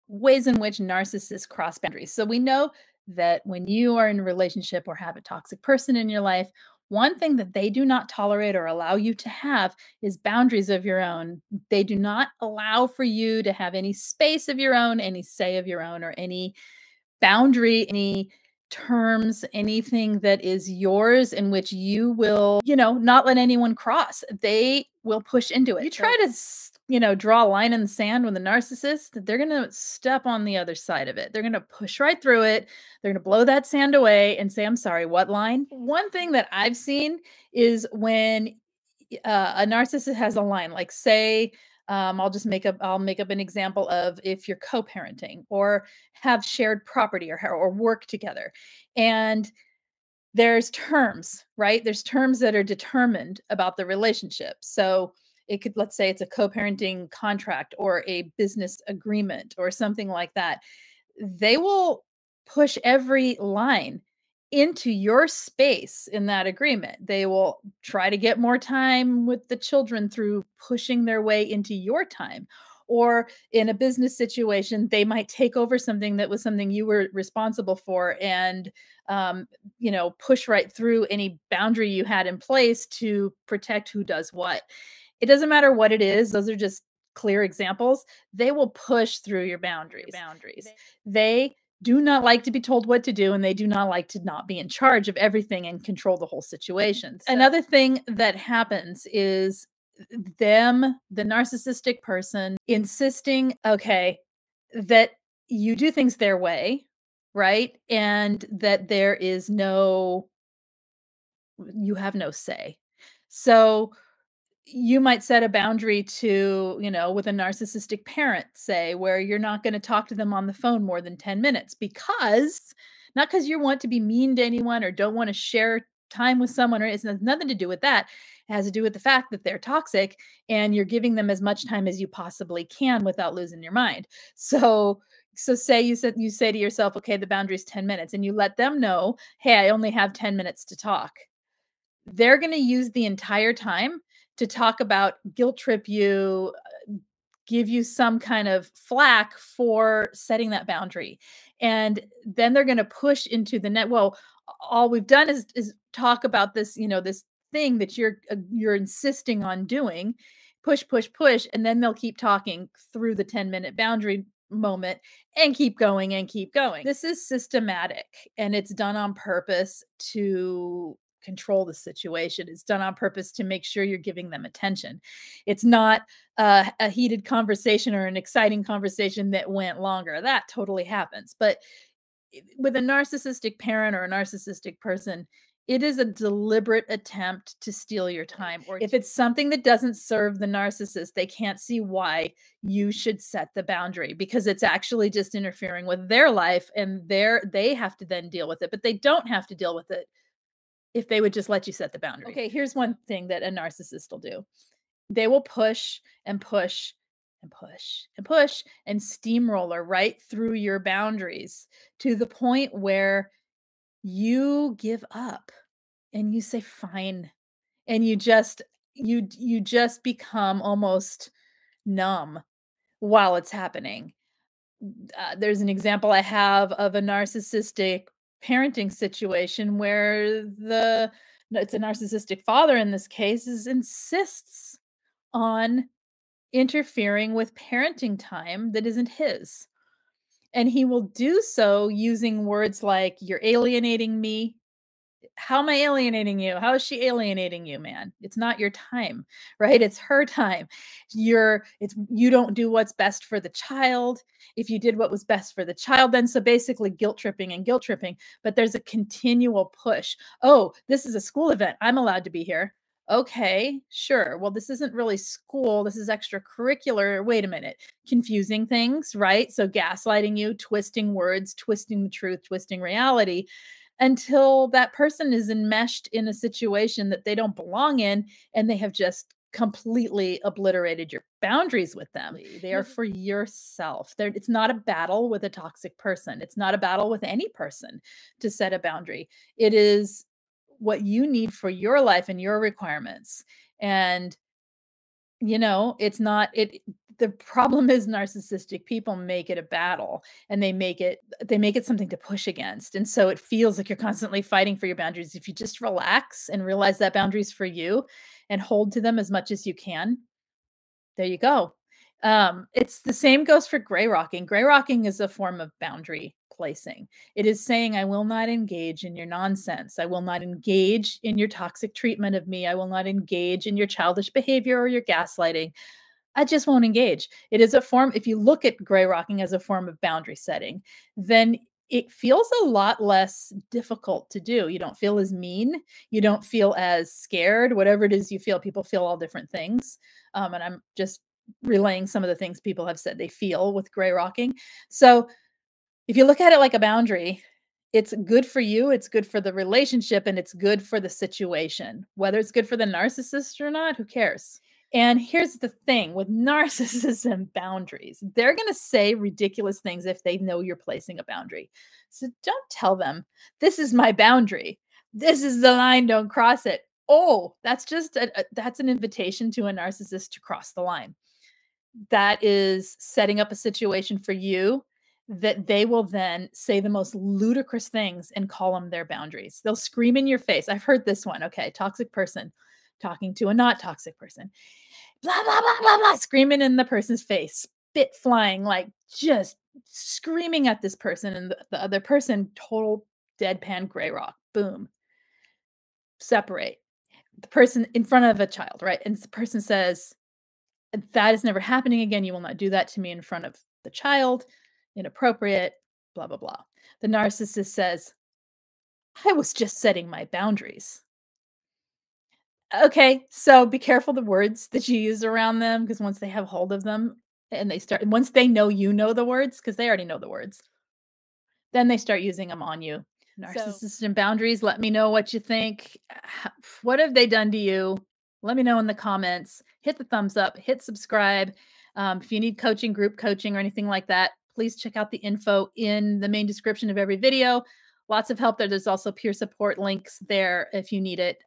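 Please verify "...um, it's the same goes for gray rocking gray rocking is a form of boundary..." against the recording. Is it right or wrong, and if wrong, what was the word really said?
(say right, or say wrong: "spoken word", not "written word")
right.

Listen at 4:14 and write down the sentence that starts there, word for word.
If you did what was best for the child, then so basically guilt tripping and guilt tripping, but there's a continual push.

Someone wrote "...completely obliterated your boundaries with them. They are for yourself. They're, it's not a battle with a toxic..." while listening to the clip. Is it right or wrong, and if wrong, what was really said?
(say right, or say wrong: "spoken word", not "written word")
right.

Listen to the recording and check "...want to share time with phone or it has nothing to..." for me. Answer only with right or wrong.
wrong.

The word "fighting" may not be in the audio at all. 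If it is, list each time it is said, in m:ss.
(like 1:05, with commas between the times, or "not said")
5:04.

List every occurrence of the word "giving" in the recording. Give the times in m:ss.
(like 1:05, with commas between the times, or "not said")
2:10, 2:53.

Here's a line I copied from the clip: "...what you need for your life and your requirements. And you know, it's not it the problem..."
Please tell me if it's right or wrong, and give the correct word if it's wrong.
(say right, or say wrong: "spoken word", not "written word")
right.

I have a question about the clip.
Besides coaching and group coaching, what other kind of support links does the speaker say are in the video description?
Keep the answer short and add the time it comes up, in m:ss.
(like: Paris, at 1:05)
peer support, at 7:19.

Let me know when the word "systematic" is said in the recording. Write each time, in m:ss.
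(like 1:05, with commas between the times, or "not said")
2:47.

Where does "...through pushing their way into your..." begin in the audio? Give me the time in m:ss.
1:10.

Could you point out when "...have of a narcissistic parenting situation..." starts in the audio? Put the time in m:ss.
3:46.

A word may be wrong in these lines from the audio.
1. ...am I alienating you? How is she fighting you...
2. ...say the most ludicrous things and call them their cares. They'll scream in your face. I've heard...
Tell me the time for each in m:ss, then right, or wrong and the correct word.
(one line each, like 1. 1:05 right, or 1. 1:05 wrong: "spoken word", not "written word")
1. 4:05 wrong: "alienating", not "fighting"
2. 6:16 wrong: "boundaries", not "cares".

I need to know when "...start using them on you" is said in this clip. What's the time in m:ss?
7:01.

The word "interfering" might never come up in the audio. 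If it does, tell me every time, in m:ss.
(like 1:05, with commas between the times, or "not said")
3:15, 3:56.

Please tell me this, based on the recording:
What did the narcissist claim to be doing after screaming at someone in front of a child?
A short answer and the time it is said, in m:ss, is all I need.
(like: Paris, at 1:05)
setting my boundaries, at 6:49.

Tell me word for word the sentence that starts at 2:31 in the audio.
And then they're going to push into the net.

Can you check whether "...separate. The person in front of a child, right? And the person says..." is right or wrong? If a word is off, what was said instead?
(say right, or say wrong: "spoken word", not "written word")
right.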